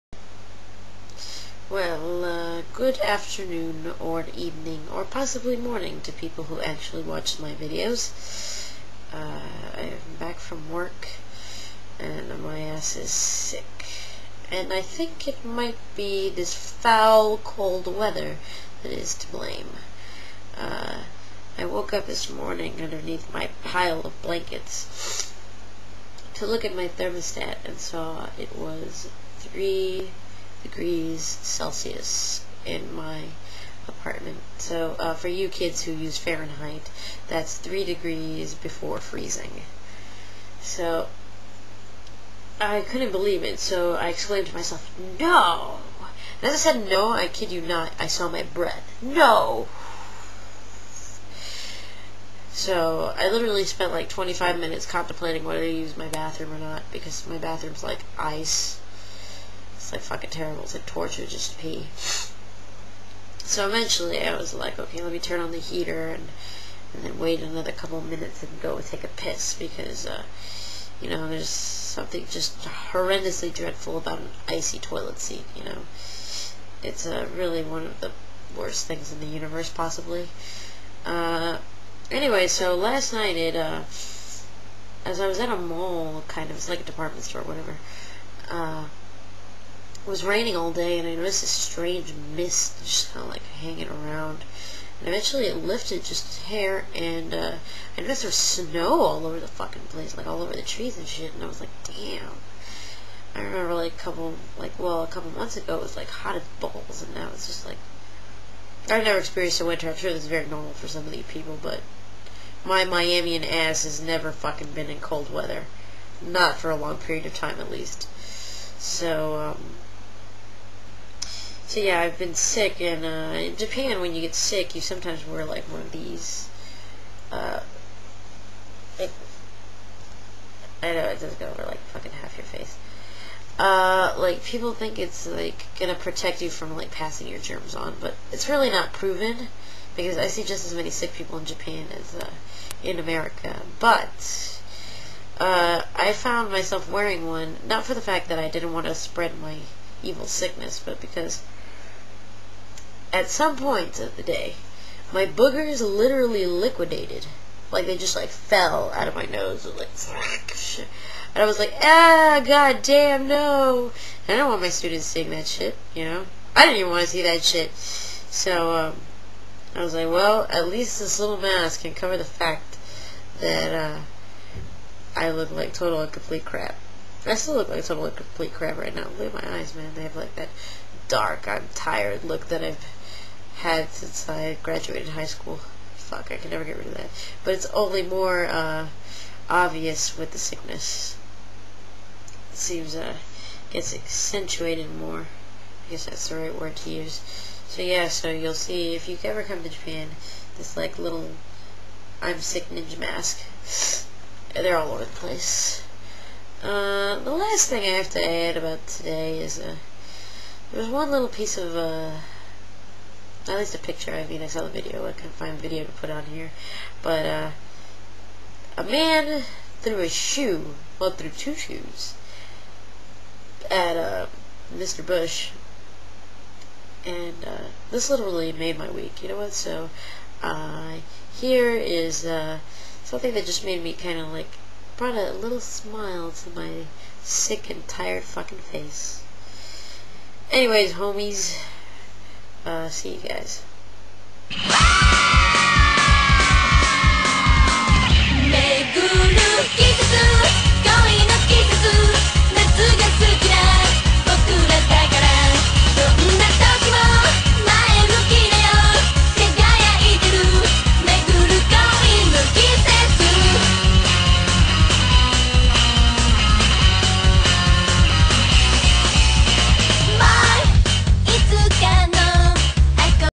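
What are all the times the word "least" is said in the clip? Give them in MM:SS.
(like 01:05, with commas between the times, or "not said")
01:57, 02:50, 03:33.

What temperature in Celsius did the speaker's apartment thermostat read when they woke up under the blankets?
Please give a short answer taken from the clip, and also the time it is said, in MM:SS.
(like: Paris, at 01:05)
3 degrees, at 00:29.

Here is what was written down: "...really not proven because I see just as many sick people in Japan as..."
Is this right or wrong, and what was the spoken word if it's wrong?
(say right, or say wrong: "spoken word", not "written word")
right.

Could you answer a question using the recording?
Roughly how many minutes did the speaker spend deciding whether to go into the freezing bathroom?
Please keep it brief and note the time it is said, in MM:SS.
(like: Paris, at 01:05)
25, at 00:54.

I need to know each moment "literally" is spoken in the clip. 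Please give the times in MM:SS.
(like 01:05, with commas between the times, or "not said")
00:53, 02:35, 03:48.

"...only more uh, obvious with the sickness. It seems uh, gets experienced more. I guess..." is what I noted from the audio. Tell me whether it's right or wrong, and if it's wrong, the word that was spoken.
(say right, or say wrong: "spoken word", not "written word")
wrong: "accentuated", not "experienced".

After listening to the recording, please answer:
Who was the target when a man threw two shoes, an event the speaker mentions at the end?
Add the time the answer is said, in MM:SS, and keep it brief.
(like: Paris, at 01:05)
Mr. Bush, at 03:44.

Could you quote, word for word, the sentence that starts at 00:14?
And I think it might be this foul cold weather that is to blame.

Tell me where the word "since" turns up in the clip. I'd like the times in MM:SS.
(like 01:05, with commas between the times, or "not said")
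03:03.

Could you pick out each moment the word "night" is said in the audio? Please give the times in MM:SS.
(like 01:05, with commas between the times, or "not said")
01:23.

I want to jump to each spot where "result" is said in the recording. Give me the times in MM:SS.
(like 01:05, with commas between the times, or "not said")
not said.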